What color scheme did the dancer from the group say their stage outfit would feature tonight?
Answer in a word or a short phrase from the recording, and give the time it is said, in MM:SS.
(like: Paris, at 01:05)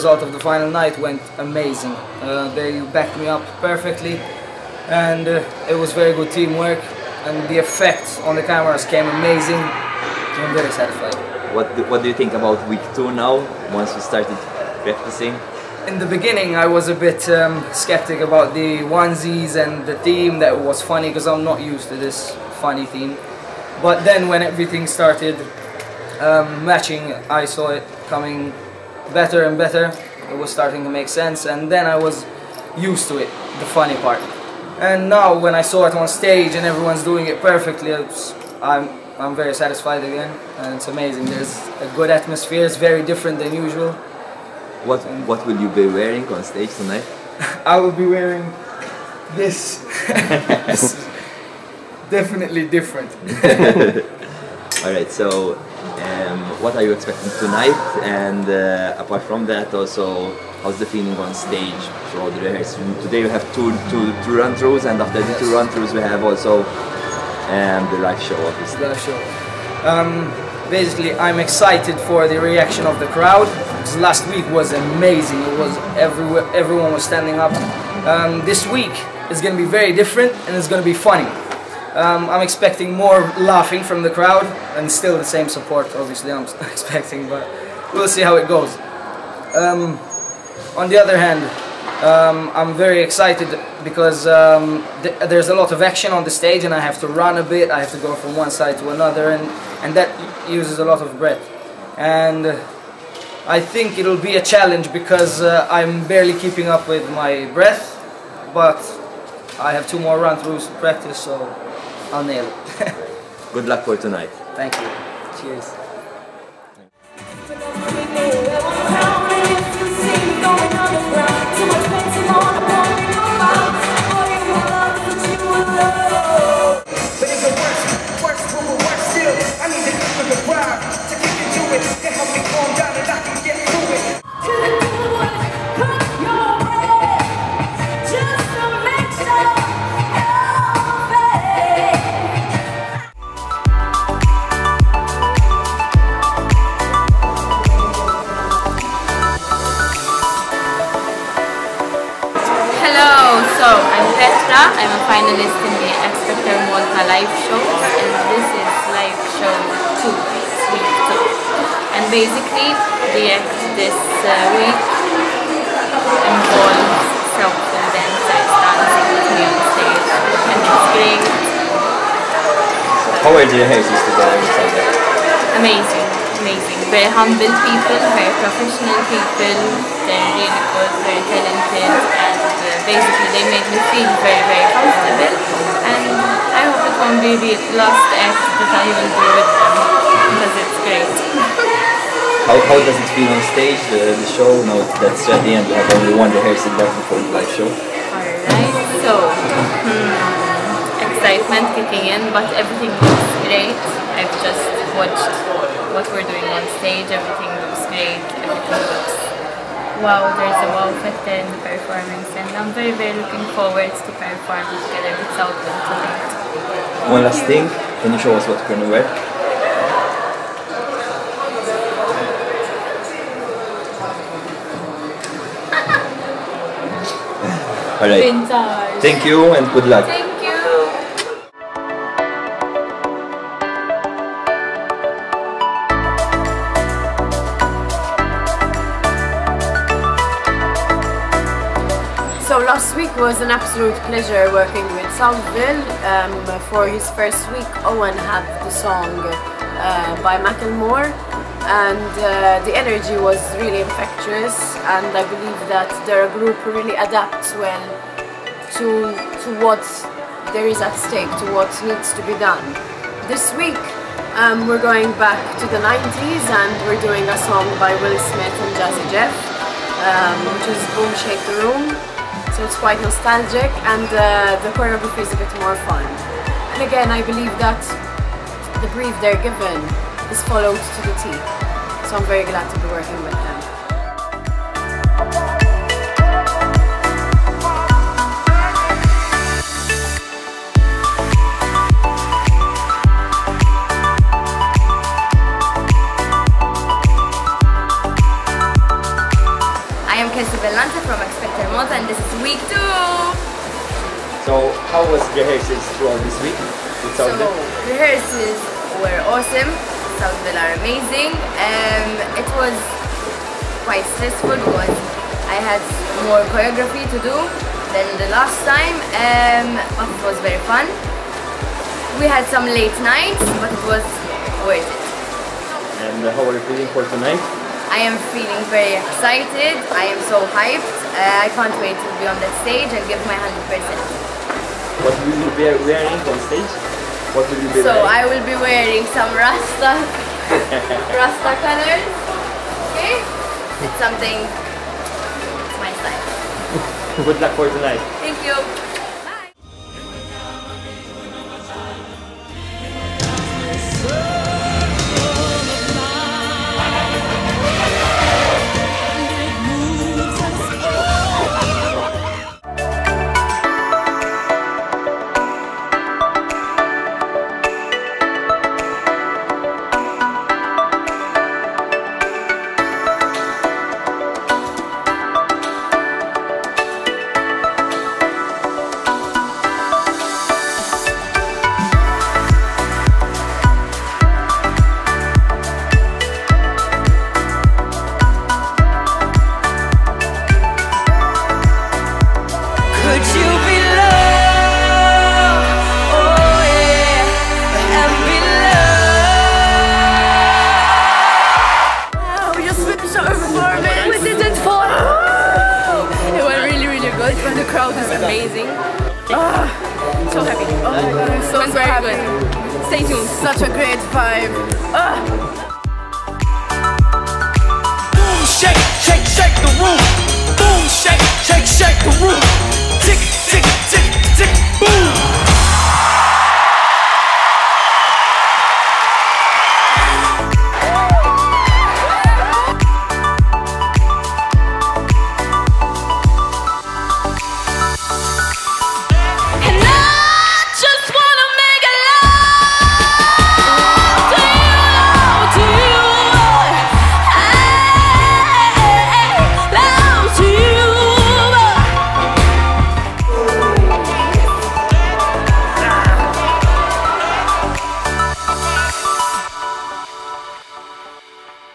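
Rasta colors, at 05:41.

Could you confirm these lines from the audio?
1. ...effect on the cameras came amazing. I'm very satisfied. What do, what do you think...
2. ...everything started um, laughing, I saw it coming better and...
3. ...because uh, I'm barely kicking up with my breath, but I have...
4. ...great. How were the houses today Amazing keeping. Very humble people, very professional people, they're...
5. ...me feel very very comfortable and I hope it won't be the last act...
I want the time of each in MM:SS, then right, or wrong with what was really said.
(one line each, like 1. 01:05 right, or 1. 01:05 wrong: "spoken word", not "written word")
1. 00:07 right
2. 00:24 wrong: "matching", not "laughing"
3. 01:44 wrong: "keeping", not "kicking"
4. 02:50 wrong: "amazing", not "keeping"
5. 03:03 right.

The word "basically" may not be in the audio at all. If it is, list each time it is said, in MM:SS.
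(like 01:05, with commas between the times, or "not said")
01:10, 02:42, 03:02.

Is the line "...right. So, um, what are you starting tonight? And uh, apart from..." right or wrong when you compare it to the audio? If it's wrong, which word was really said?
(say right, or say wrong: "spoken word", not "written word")
wrong: "expecting", not "starting".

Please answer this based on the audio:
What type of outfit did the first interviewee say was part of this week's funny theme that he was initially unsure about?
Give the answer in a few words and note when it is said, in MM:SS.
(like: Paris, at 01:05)
Onesies, at 00:18.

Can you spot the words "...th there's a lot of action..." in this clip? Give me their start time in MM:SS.
01:35.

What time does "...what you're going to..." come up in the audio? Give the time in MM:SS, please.
03:38.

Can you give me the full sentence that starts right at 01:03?
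Today we have two, two, two run-throughs, and after yes.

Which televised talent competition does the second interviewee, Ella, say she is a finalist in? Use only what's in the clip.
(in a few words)
X Factor Malta.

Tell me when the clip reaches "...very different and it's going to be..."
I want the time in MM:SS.
01:19.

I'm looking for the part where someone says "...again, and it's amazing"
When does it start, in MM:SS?
00:40.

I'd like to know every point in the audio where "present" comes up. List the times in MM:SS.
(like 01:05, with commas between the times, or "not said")
not said.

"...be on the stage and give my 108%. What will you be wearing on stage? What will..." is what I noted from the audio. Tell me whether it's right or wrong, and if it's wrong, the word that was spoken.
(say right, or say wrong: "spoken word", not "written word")
wrong: "100", not "108".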